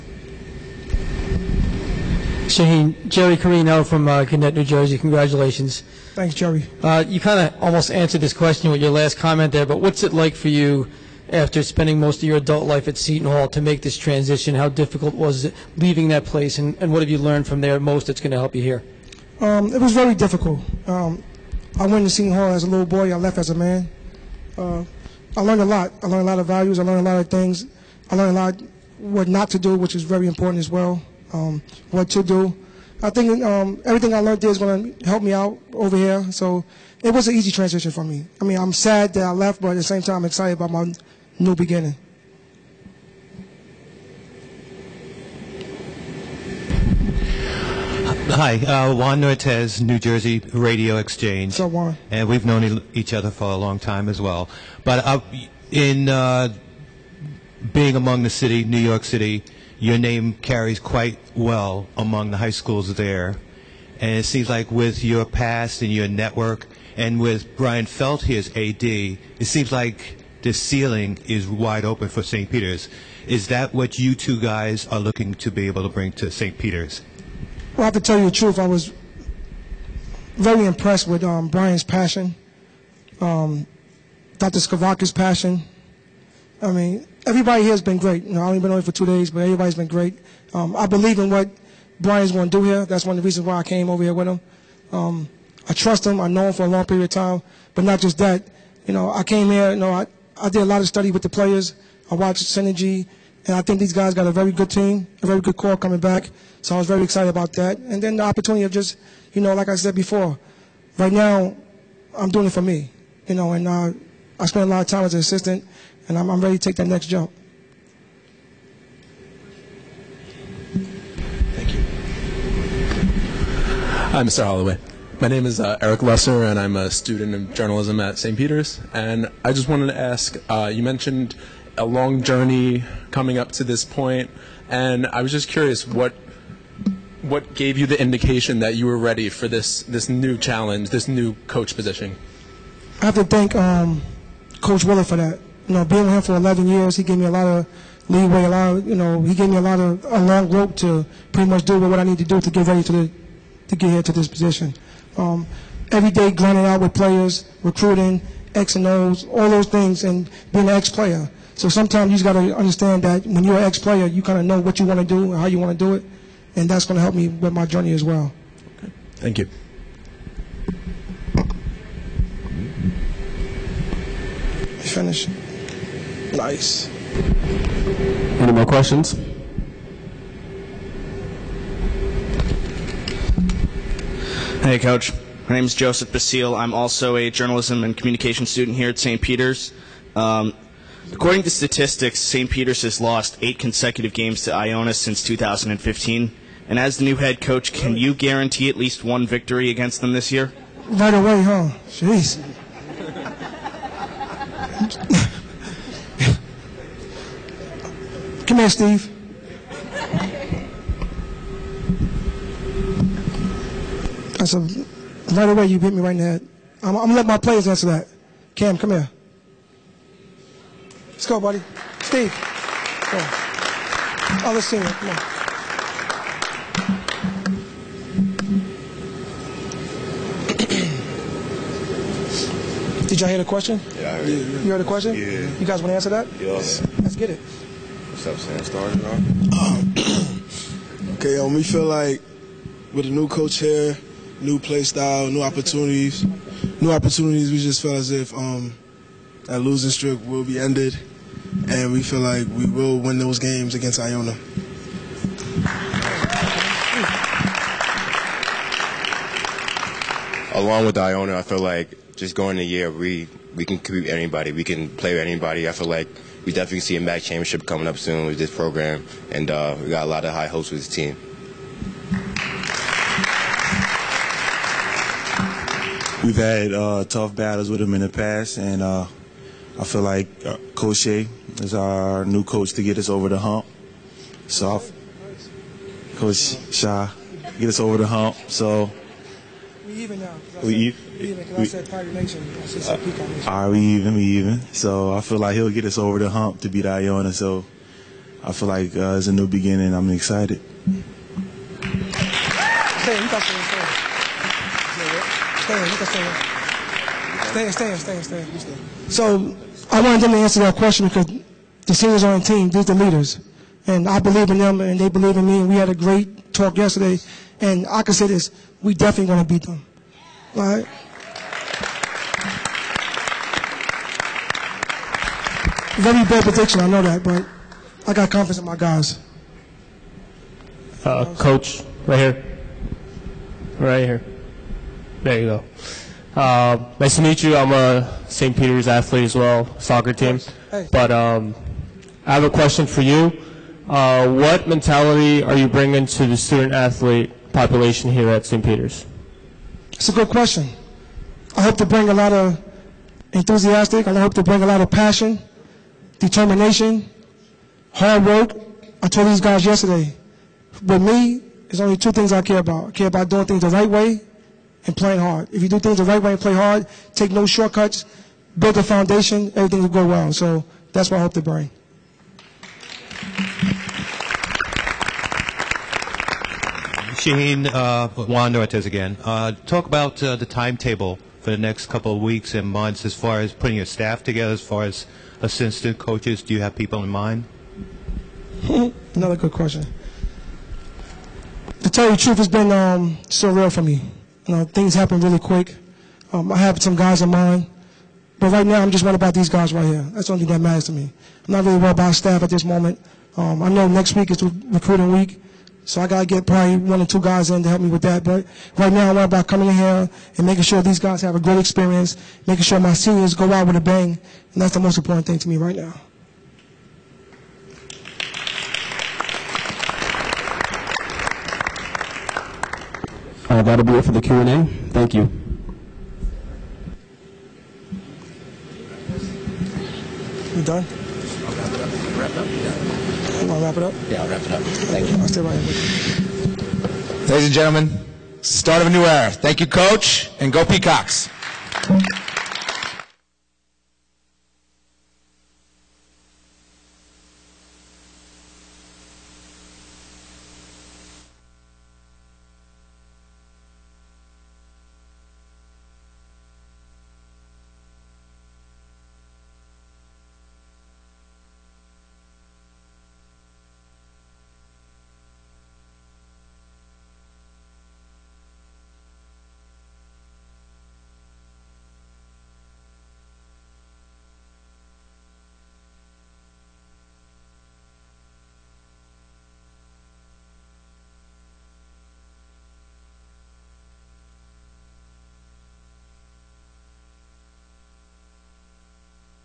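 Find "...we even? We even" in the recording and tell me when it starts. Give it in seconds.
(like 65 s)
293 s.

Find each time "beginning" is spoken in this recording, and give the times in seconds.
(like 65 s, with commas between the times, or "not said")
41 s, 299 s.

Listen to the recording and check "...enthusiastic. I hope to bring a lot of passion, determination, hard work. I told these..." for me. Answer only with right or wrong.
right.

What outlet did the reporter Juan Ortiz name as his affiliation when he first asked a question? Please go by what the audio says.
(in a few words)
New Jersey Radio Exchange.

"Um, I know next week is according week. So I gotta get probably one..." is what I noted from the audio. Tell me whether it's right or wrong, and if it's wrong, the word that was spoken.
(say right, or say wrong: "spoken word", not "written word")
wrong: "recruiting", not "according".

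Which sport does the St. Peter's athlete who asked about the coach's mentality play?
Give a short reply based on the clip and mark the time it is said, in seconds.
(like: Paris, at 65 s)
Soccer, at 339 s.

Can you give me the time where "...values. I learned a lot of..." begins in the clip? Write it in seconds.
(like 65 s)
26 s.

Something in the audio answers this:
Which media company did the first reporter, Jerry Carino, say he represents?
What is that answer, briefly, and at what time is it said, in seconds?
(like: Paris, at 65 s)
Gannett, at 4 s.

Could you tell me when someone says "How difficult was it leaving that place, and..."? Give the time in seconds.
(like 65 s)
14 s.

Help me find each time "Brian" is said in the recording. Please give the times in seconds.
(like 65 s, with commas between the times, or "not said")
67 s, 81 s, 91 s.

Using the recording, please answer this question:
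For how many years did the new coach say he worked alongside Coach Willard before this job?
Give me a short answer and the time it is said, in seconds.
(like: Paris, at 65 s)
11, at 146 s.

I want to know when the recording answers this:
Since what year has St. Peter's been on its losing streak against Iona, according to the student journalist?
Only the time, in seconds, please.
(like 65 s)
195 s.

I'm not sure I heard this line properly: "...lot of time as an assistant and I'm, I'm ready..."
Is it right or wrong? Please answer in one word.
right.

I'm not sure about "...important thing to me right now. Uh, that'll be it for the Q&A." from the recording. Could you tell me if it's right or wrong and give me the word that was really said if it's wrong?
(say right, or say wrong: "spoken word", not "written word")
right.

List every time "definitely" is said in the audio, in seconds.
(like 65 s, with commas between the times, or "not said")
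266 s, 318 s.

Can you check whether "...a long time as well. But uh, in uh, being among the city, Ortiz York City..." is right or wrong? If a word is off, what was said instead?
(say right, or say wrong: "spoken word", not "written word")
wrong: "New", not "Ortiz".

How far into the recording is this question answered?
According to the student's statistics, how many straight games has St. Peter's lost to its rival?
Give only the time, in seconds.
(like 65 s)
193 s.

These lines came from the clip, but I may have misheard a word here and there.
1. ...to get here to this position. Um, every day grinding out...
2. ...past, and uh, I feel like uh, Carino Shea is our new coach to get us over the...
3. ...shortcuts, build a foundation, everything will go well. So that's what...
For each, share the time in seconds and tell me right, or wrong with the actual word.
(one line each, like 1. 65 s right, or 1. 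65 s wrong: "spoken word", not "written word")
1. 153 s right
2. 278 s wrong: "Coach", not "Carino"
3. 367 s right.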